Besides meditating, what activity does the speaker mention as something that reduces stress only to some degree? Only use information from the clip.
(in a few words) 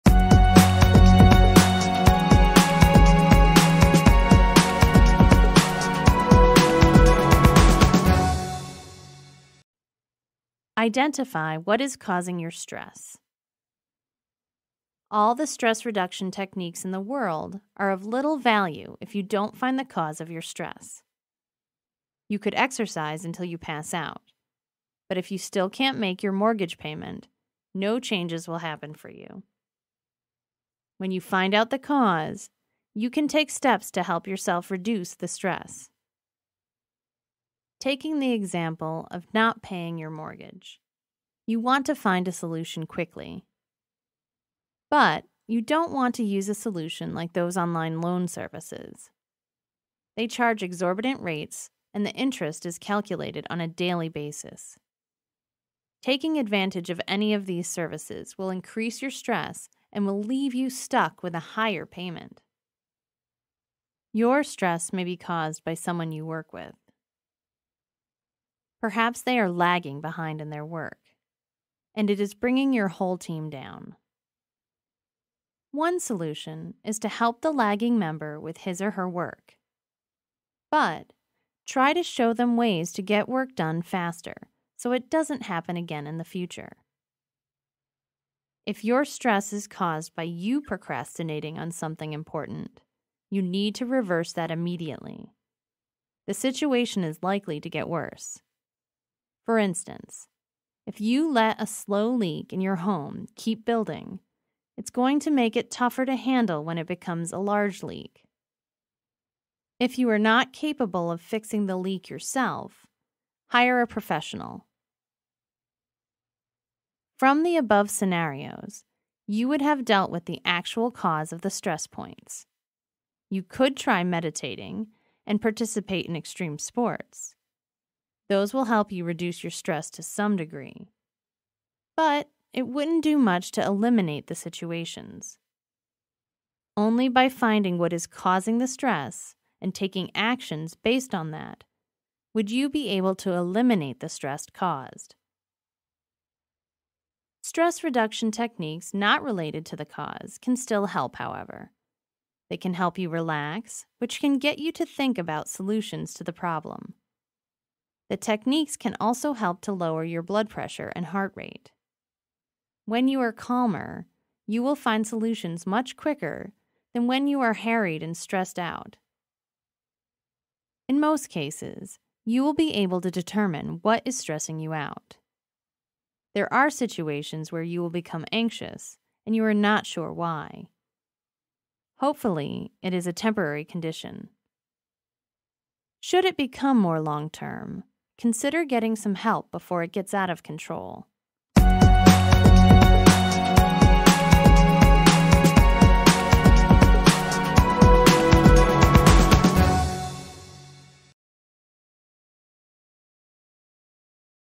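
extreme sports.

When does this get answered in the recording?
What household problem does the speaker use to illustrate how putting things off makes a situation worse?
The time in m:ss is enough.
1:41.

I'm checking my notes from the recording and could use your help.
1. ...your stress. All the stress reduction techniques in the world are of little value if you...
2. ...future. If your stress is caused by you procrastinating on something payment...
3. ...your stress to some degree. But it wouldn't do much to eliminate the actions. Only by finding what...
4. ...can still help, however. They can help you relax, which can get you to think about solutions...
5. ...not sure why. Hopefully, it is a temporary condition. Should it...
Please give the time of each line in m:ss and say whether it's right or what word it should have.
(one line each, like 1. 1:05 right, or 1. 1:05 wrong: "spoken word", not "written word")
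1. 0:12 right
2. 1:26 wrong: "important", not "payment"
3. 2:09 wrong: "situations", not "actions"
4. 2:30 right
5. 2:59 right.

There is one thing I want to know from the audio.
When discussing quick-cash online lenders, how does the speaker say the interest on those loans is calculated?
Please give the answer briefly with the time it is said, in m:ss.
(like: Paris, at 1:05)
on a daily basis, at 0:53.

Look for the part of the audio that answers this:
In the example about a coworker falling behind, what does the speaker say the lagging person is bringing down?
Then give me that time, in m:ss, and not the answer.
1:12.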